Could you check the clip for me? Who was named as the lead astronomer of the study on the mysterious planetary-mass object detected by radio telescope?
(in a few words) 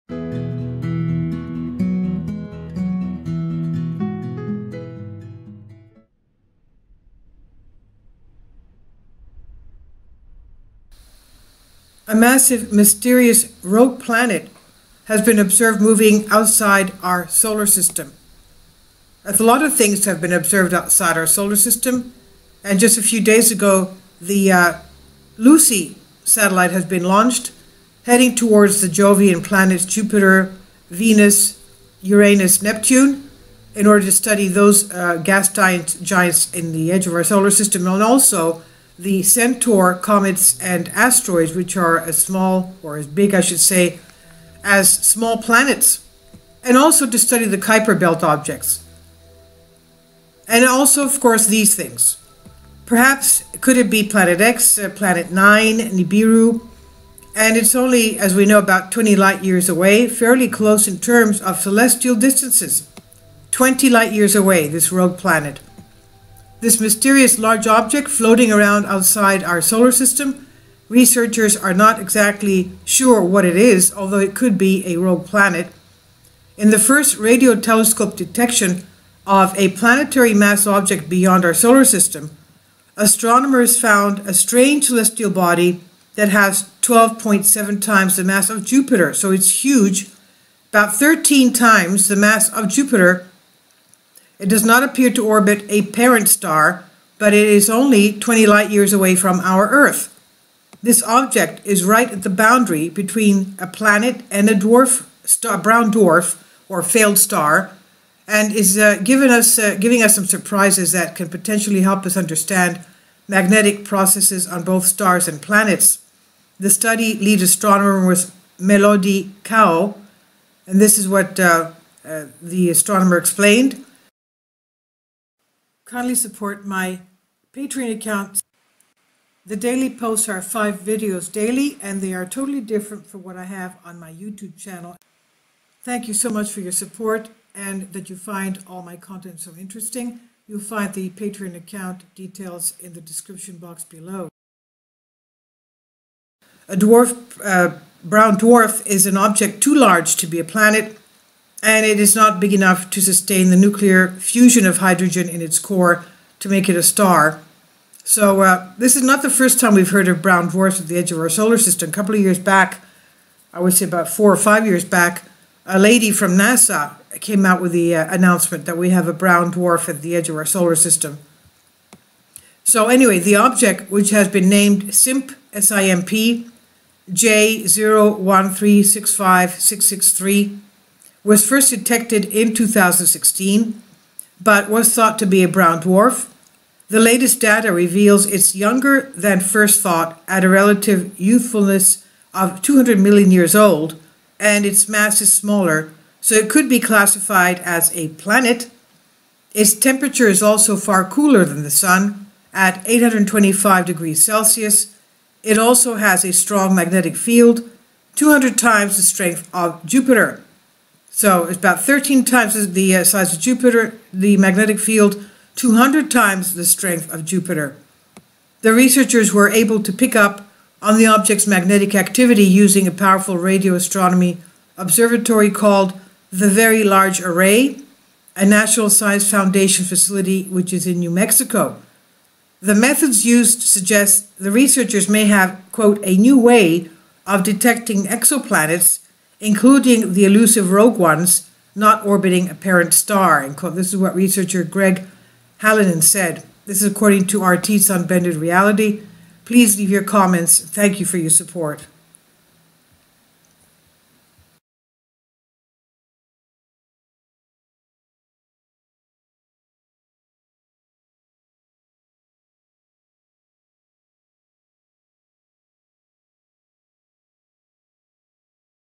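Melody Kao.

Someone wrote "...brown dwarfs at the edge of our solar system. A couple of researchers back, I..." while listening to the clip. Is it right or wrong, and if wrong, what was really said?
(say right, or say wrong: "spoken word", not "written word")
wrong: "years", not "researchers".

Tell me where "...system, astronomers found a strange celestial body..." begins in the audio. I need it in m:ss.
1:21.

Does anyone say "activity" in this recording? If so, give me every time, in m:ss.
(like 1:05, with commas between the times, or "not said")
3:41.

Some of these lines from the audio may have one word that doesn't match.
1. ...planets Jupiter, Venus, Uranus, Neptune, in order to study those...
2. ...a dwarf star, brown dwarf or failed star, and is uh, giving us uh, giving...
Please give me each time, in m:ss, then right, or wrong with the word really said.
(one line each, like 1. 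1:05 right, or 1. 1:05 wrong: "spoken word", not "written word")
1. 0:29 right
2. 1:44 right.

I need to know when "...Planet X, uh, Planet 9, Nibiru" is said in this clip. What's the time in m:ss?
0:54.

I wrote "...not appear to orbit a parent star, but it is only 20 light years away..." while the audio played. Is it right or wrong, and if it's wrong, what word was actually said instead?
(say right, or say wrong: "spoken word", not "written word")
right.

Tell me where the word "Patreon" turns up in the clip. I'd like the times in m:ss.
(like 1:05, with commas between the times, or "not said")
2:07, 2:21.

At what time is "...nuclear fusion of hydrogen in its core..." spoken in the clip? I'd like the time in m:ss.
2:33.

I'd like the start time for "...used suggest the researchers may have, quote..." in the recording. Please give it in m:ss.
3:53.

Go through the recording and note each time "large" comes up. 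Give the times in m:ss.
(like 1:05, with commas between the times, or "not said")
1:07, 2:29, 3:46.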